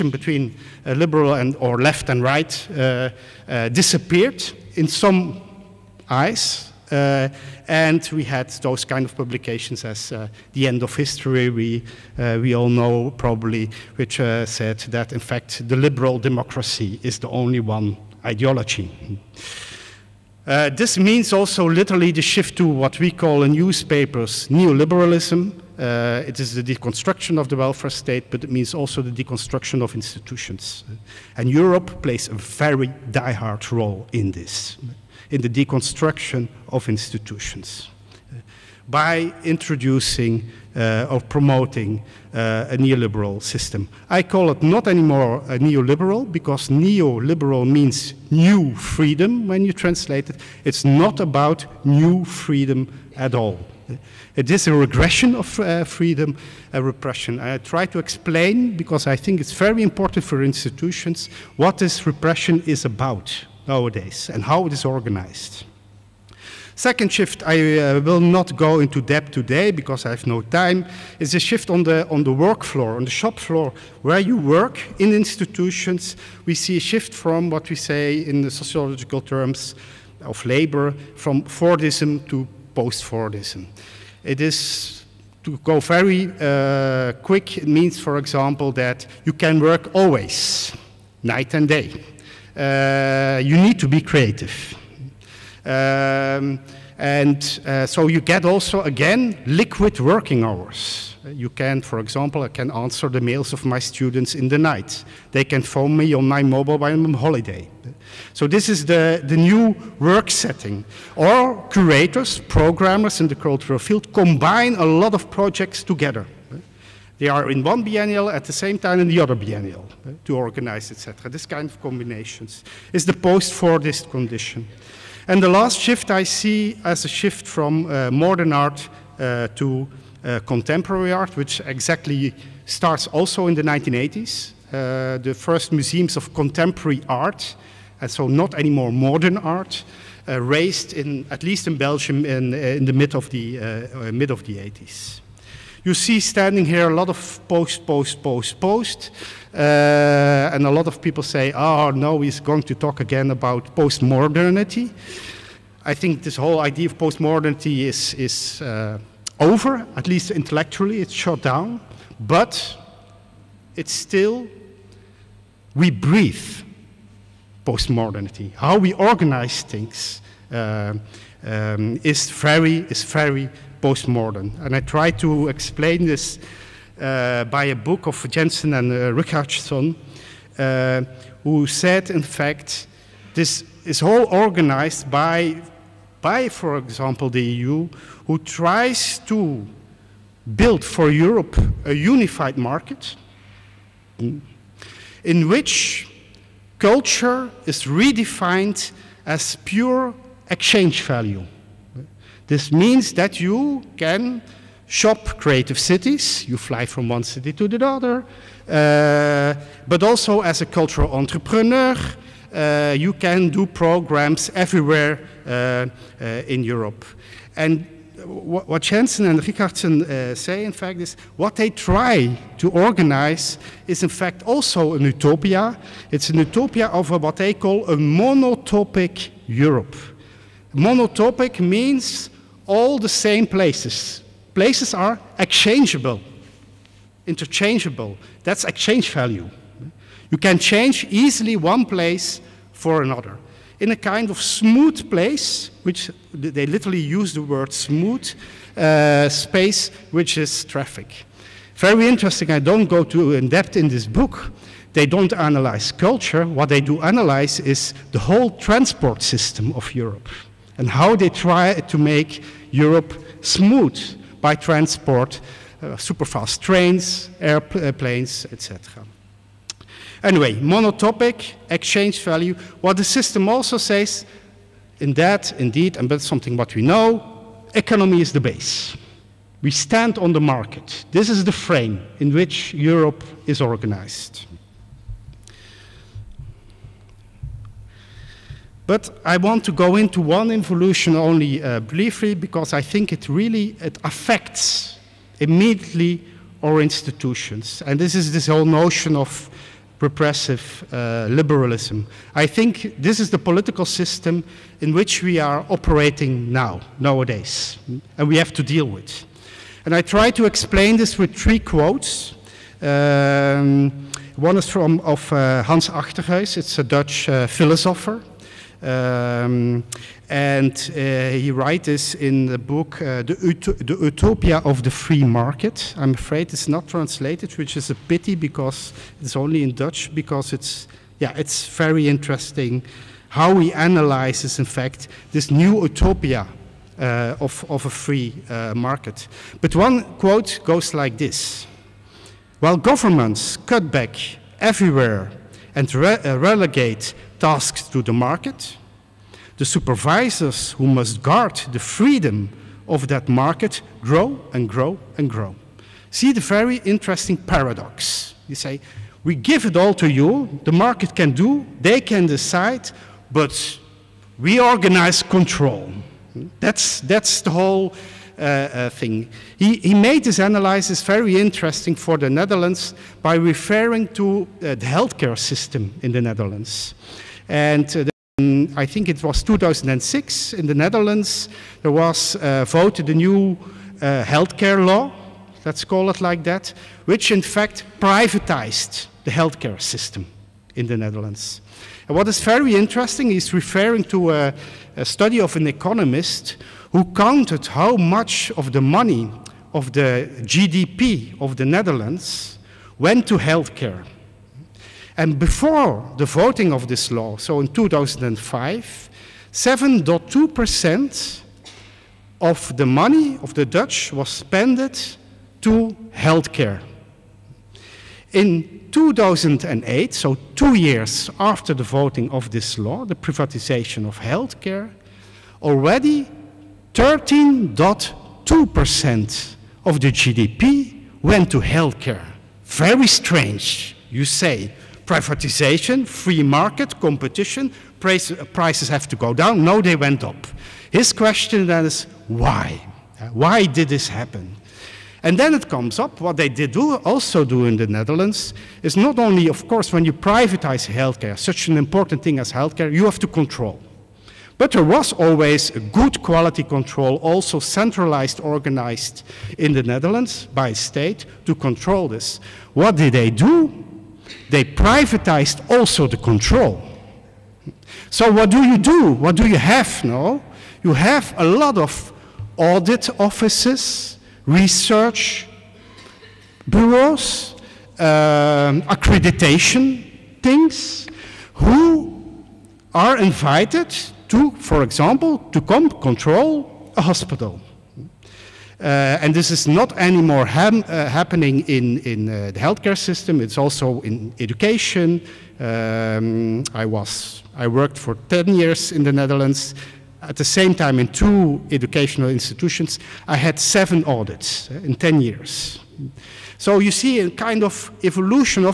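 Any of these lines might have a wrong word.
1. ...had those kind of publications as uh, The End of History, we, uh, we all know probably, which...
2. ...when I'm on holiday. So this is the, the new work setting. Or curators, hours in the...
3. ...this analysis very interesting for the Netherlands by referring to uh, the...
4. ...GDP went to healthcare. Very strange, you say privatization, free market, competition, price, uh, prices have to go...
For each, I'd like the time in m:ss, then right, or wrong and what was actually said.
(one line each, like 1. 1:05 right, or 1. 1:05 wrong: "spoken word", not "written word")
1. 0:08 right
2. 1:46 wrong: "programmers", not "hours"
3. 6:10 right
4. 7:10 right.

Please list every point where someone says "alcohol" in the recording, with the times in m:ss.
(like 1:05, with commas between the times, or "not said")
not said.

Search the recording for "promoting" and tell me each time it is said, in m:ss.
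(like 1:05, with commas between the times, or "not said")
0:41.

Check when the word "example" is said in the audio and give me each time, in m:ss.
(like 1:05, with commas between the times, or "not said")
1:28, 1:41, 3:06, 8:04.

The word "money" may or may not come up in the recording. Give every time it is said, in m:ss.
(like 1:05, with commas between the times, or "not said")
6:38, 6:52.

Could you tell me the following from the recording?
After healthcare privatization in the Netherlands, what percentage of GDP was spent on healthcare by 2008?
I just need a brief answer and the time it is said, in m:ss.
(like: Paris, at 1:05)
13.2%, at 7:06.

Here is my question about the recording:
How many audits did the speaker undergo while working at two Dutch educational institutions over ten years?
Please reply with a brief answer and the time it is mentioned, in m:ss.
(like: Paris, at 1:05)
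7, at 8:23.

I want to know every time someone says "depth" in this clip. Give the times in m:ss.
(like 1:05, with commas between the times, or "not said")
1:09, 4:13.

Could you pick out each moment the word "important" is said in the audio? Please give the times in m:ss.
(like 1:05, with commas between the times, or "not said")
0:59, 7:31.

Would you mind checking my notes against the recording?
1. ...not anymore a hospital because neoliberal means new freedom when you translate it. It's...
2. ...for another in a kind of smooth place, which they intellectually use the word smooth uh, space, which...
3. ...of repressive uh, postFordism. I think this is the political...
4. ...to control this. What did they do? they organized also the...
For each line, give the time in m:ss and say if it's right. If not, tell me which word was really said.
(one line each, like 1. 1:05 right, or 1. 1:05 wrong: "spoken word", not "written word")
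1. 0:44 wrong: "neoliberal", not "hospital"
2. 4:02 wrong: "literally", not "intellectually"
3. 4:59 wrong: "liberalism", not "postFordism"
4. 7:41 wrong: "privatized", not "organized".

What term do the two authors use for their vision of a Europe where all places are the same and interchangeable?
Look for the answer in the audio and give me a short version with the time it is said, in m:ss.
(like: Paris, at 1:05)
monotopic Europe, at 3:47.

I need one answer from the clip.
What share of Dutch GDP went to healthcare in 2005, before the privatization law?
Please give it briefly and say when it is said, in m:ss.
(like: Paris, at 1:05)
7.2%, at 6:49.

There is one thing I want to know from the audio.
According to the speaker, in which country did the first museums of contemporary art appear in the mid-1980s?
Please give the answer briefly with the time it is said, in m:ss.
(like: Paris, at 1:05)
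Belgium, at 2:21.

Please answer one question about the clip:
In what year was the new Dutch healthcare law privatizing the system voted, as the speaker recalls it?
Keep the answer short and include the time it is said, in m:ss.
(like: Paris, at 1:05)
2006, at 6:19.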